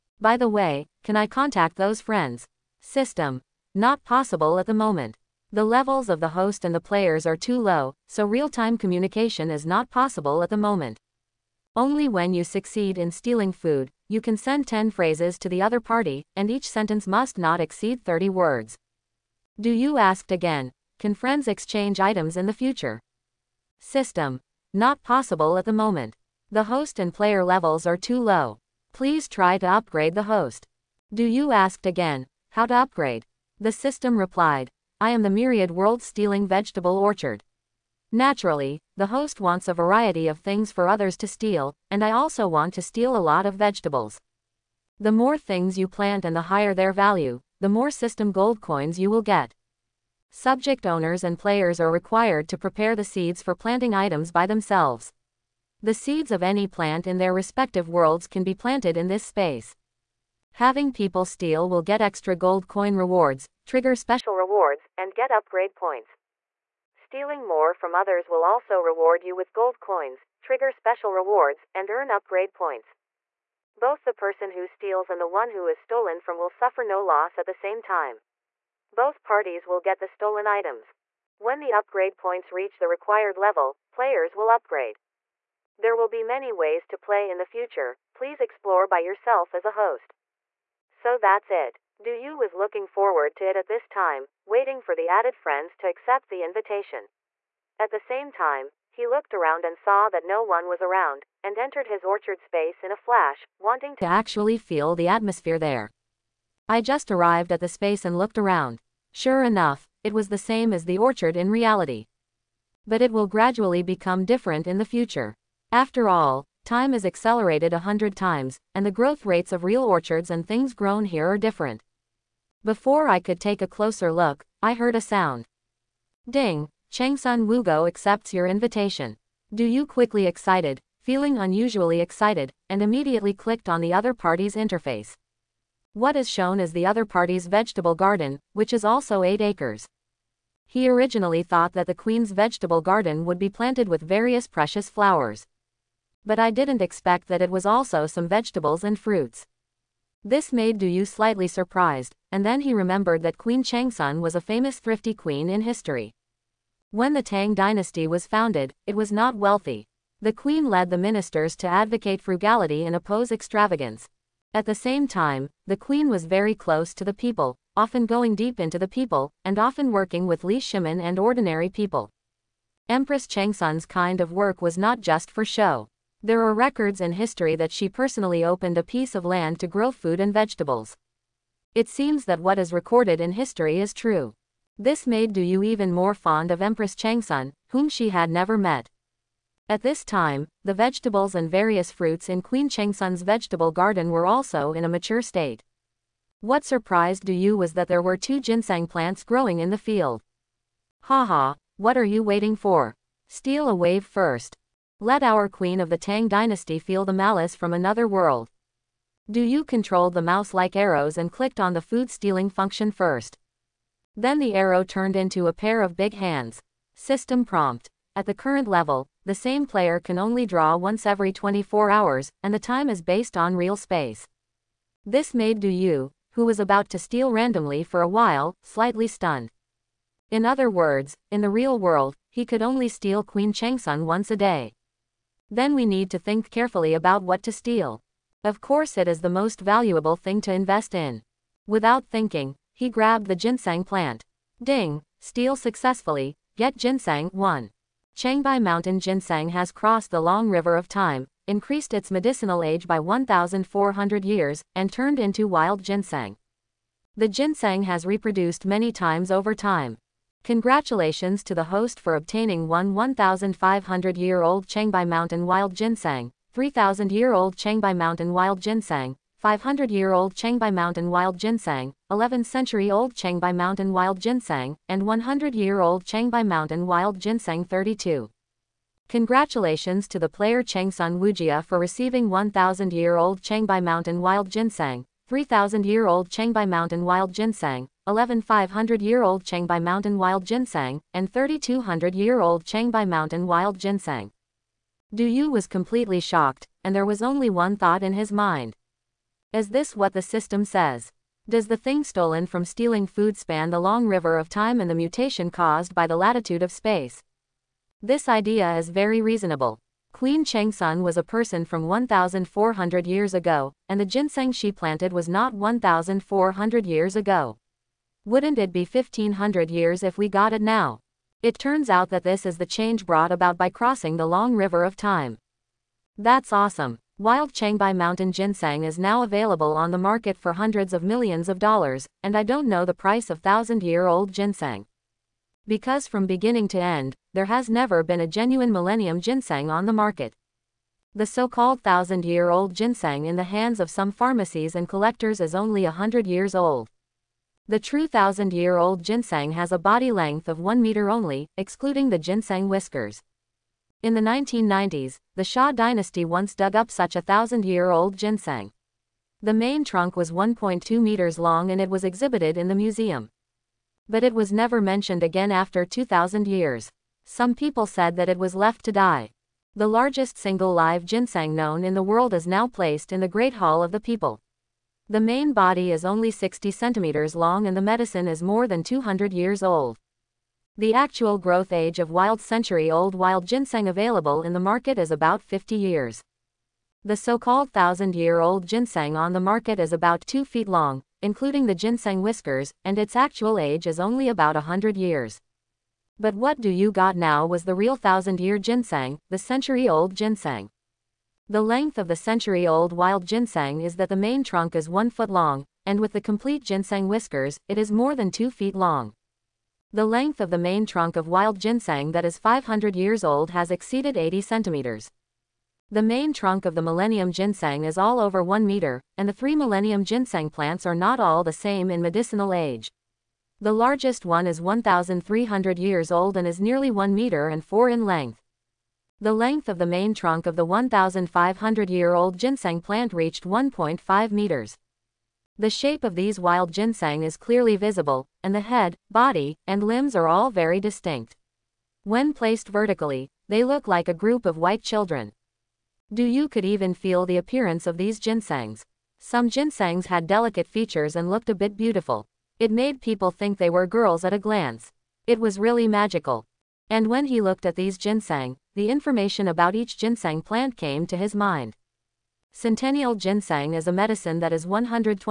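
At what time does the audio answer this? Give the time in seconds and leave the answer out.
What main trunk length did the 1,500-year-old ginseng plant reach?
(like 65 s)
433 s.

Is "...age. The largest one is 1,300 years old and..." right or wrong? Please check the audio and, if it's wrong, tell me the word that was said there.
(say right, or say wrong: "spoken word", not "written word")
right.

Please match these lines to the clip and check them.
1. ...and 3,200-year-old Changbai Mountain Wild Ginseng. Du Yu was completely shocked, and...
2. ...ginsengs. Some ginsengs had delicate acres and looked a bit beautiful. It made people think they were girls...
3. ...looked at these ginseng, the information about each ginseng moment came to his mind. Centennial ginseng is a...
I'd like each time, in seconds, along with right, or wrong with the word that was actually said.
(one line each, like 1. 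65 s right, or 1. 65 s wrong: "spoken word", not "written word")
1. 291 s right
2. 448 s wrong: "features", not "acres"
3. 457 s wrong: "plant", not "moment".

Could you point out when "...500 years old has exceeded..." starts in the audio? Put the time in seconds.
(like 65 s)
412 s.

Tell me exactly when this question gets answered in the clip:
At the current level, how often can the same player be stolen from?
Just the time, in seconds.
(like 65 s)
220 s.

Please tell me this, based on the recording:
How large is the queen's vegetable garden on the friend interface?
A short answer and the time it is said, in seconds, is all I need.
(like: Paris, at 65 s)
8 acres, at 139 s.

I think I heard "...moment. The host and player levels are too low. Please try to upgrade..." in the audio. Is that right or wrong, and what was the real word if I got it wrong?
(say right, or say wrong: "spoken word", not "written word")
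right.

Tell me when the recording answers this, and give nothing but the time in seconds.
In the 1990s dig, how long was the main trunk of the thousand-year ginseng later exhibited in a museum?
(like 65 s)
360 s.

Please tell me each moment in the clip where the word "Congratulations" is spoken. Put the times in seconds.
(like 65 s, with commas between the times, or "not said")
260 s, 279 s.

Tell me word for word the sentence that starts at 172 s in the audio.
Empress Changsun's kind of work was not just for show.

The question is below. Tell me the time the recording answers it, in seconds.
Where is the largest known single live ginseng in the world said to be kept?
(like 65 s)
373 s.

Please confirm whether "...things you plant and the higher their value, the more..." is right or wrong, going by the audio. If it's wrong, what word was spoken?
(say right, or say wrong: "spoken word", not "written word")
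right.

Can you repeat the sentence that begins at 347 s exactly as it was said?
The true thousand-year-old ginseng has a body length of one meter only, excluding the ginseng whiskers.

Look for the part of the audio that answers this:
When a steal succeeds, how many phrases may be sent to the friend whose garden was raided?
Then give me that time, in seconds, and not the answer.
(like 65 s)
14 s.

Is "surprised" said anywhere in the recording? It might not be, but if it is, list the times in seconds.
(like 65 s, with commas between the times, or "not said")
151 s, 196 s.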